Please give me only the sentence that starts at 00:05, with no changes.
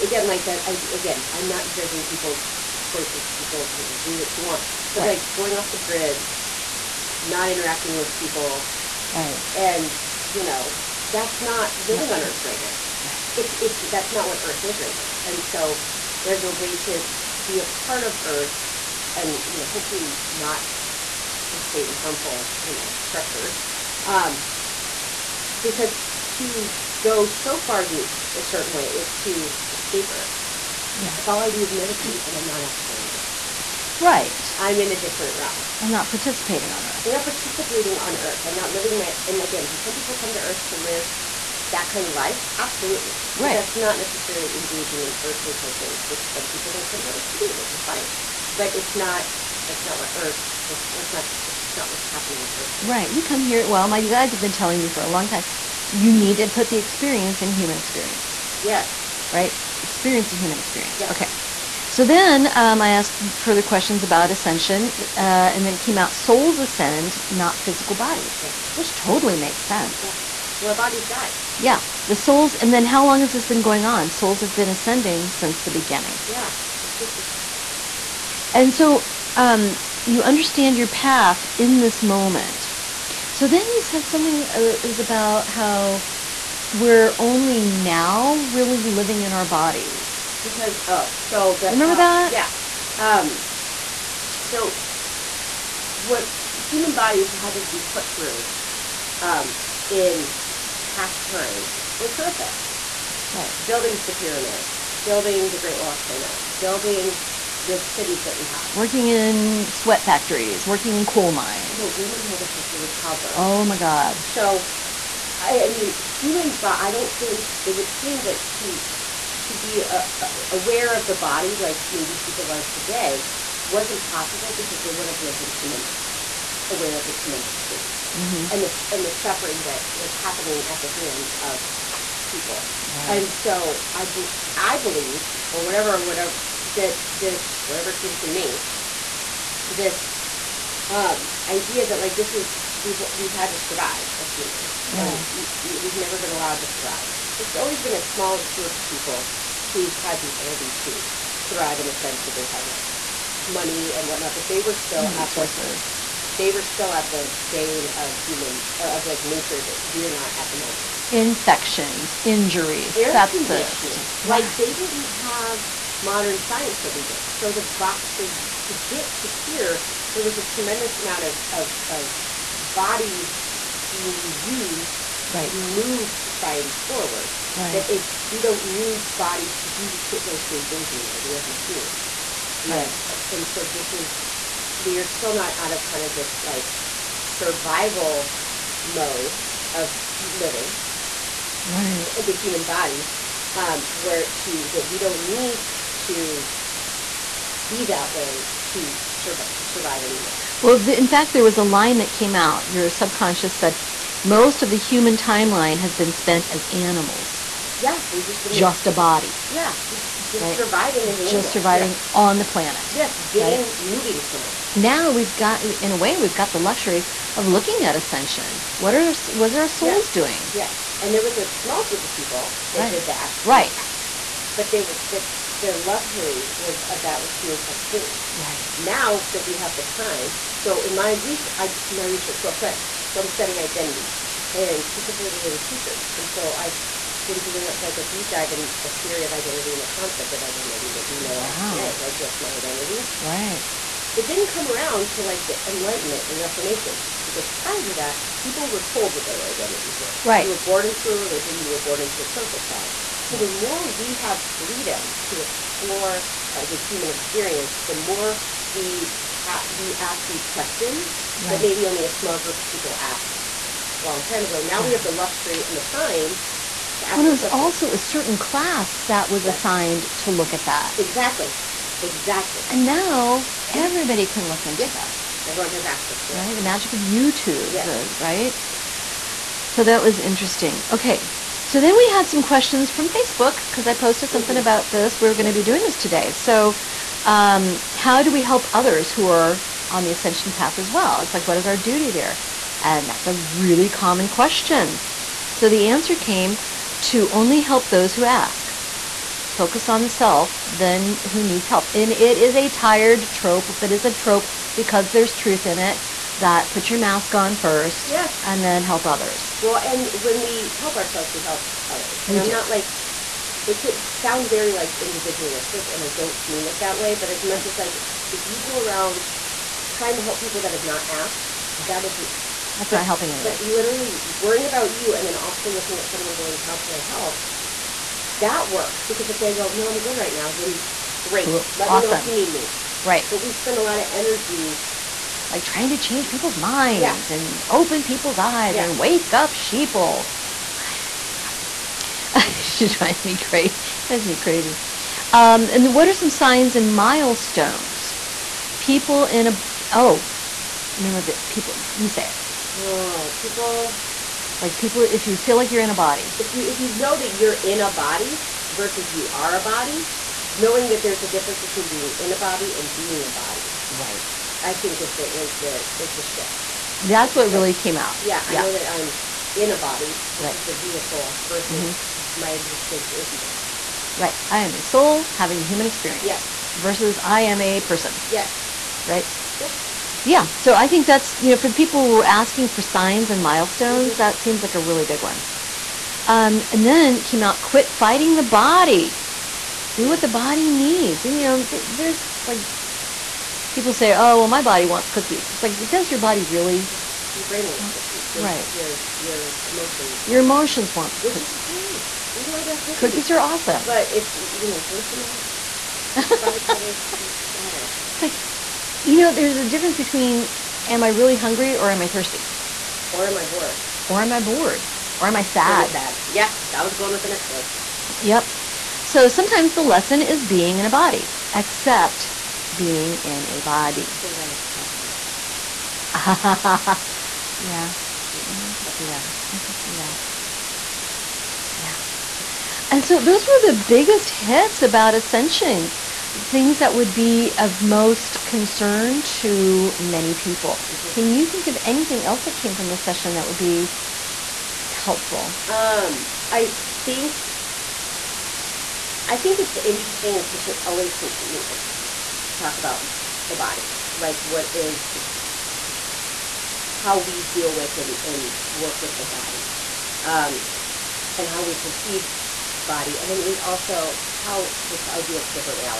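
like going off the grid, not interacting with people, right?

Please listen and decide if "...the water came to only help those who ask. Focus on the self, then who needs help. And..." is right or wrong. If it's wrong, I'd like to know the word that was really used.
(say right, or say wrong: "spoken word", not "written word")
wrong: "answer", not "water".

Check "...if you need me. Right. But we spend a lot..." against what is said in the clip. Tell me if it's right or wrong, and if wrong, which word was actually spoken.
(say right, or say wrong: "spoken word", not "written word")
right.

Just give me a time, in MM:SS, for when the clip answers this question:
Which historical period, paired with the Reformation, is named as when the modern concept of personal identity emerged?
04:05.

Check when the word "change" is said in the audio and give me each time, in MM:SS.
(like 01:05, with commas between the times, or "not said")
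05:35.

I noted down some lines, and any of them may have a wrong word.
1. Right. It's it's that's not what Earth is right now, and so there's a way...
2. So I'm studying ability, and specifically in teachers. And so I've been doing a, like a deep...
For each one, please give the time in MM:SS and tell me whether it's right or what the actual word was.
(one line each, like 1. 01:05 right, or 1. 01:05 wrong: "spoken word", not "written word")
1. 00:12 right
2. 03:53 wrong: "identity", not "ability".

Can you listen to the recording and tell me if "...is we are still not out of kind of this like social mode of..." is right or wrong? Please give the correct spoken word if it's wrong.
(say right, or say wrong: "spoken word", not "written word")
wrong: "survival", not "social".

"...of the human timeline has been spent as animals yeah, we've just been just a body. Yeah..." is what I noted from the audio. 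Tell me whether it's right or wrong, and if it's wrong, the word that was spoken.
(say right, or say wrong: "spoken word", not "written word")
right.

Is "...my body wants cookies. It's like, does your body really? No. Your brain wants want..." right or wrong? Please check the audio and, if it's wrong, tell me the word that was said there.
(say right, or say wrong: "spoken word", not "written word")
right.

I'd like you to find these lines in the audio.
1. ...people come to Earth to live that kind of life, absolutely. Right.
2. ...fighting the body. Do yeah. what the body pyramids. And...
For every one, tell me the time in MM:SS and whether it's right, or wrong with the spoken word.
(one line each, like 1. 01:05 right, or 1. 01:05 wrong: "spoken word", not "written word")
1. 00:39 right
2. 06:27 wrong: "needs", not "pyramids".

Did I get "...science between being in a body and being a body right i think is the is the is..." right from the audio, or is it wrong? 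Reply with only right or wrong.
wrong.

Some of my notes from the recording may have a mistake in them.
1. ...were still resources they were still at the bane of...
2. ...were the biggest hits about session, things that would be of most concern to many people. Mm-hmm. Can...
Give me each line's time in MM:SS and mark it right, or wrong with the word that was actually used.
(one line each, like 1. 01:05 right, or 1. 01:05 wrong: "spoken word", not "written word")
1. 02:34 right
2. 07:13 wrong: "ascension", not "session".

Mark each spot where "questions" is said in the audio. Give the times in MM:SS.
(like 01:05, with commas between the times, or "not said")
01:03, 04:20, 04:42, 04:54.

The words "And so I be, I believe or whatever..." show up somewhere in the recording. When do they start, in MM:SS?
02:13.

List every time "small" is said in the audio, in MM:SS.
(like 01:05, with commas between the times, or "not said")
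02:28, 03:41, 04:22.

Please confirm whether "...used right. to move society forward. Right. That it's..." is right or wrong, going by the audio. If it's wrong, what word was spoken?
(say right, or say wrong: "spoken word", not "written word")
right.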